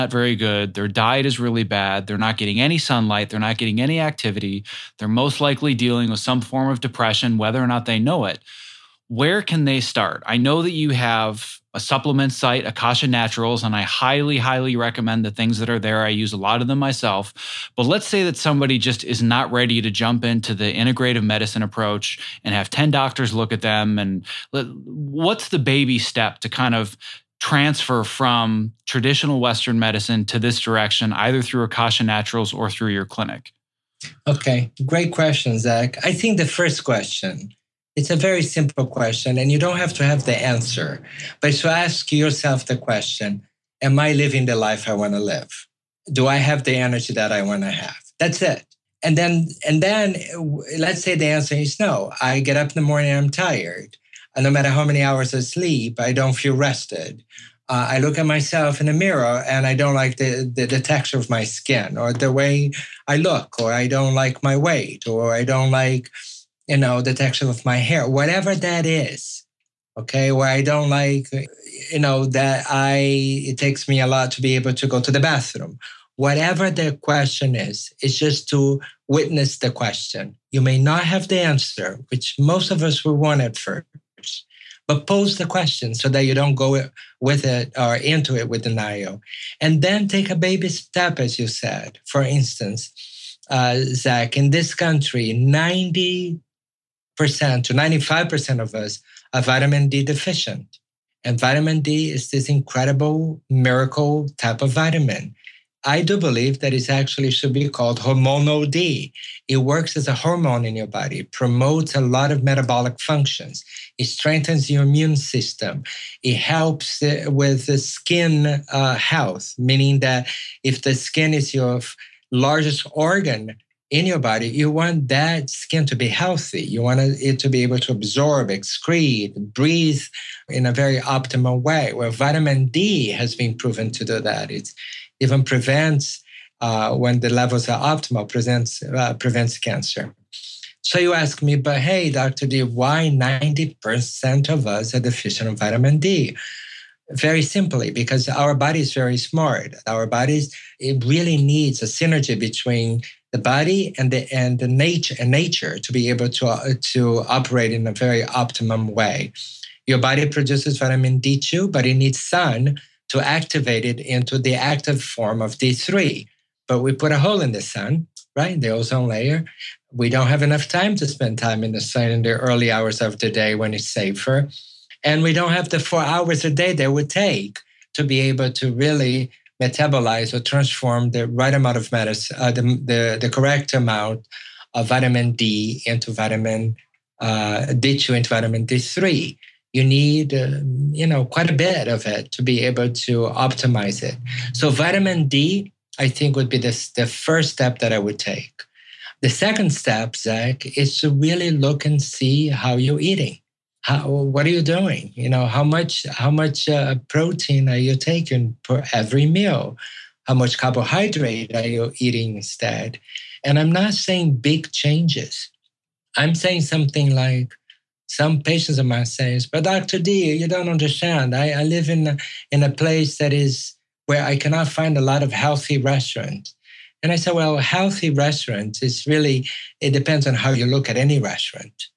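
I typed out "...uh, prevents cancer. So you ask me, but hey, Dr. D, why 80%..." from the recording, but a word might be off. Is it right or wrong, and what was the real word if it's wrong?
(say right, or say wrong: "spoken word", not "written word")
wrong: "90", not "80".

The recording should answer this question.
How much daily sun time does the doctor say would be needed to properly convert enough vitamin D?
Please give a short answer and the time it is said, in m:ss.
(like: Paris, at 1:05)
4 hours a day, at 2:55.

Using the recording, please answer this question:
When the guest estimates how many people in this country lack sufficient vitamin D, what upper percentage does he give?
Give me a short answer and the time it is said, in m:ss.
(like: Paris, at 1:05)
95%, at 1:37.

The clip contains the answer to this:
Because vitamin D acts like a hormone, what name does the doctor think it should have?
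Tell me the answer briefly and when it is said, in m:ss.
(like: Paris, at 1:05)
hormonal D, at 1:48.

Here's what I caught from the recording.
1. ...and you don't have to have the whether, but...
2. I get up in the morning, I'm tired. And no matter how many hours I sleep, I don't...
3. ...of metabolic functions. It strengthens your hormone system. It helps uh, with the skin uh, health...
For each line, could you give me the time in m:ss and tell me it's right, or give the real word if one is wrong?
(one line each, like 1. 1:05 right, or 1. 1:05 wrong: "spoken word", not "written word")
1. 0:39 wrong: "answer", not "whether"
2. 0:52 right
3. 1:52 wrong: "immune", not "hormone".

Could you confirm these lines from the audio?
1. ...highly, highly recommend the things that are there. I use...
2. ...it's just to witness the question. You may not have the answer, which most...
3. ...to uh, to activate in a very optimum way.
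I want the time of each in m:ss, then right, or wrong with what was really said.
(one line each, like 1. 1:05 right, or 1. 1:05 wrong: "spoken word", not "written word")
1. 0:13 right
2. 1:18 right
3. 2:36 wrong: "operate", not "activate".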